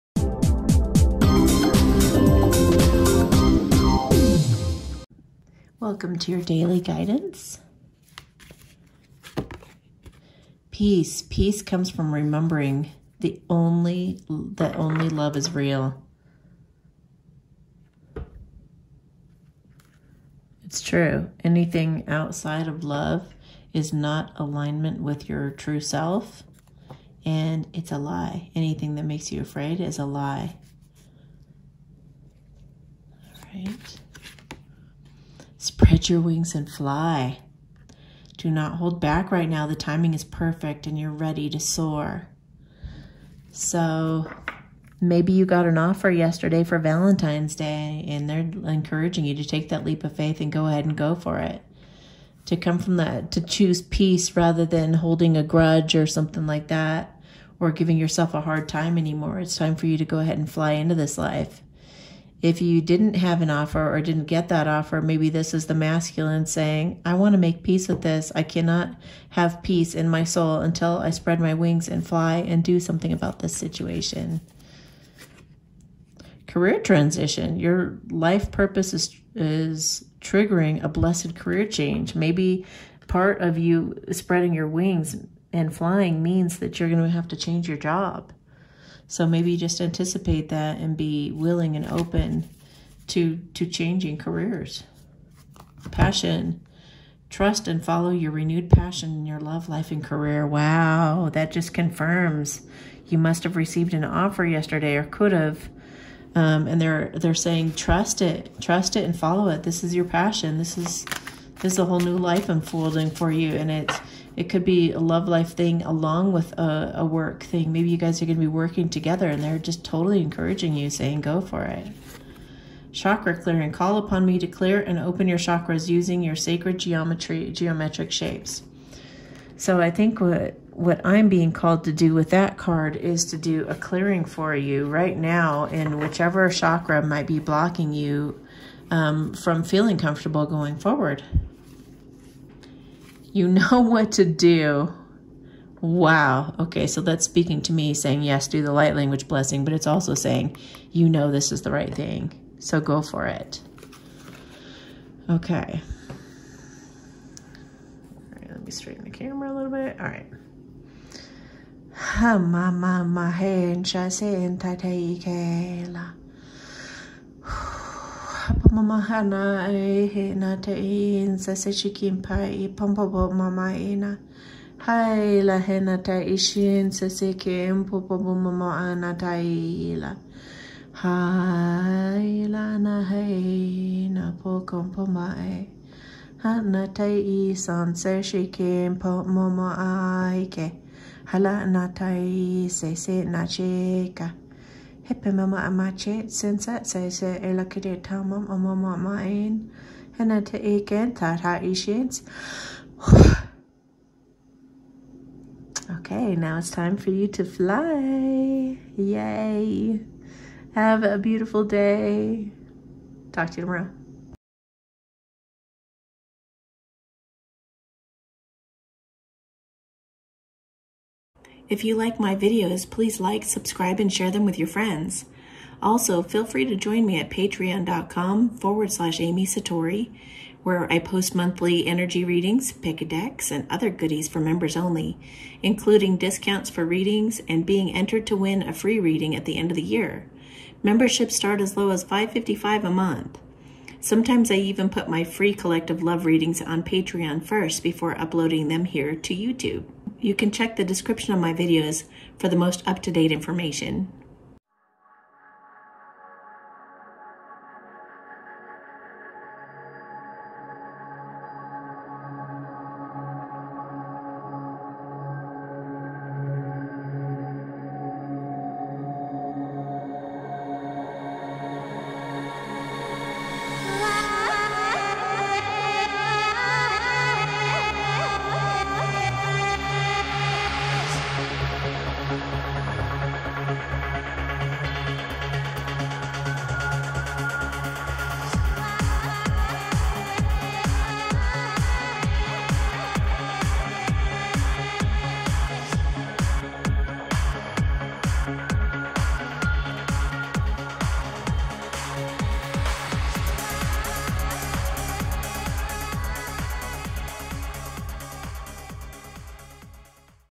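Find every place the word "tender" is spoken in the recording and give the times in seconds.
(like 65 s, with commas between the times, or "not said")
not said.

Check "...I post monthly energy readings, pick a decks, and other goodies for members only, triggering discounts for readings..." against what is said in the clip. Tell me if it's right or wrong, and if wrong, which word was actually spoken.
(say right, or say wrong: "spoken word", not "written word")
wrong: "including", not "triggering".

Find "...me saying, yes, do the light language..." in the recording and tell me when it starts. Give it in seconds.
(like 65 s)
147 s.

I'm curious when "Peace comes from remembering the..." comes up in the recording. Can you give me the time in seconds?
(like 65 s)
11 s.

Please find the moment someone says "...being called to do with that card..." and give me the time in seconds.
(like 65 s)
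131 s.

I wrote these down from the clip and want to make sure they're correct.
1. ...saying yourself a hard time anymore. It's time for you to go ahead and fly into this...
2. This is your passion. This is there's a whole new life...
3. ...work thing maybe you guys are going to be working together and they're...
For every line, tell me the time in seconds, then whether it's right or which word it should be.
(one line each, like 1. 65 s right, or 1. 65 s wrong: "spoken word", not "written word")
1. 57 s wrong: "giving", not "saying"
2. 109 s right
3. 117 s right.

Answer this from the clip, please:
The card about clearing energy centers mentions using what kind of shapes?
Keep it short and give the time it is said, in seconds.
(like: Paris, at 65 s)
Sacred geometry, at 126 s.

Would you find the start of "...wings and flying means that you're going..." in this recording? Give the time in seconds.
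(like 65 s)
84 s.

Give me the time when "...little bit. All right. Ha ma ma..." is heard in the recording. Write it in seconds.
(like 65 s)
159 s.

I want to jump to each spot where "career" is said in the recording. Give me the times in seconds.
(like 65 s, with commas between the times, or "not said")
76 s, 81 s, 94 s, 100 s.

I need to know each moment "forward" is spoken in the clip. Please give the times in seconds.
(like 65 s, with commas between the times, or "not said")
140 s, 228 s.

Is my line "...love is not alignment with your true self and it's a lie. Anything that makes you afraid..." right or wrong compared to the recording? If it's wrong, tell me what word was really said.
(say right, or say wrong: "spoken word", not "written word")
right.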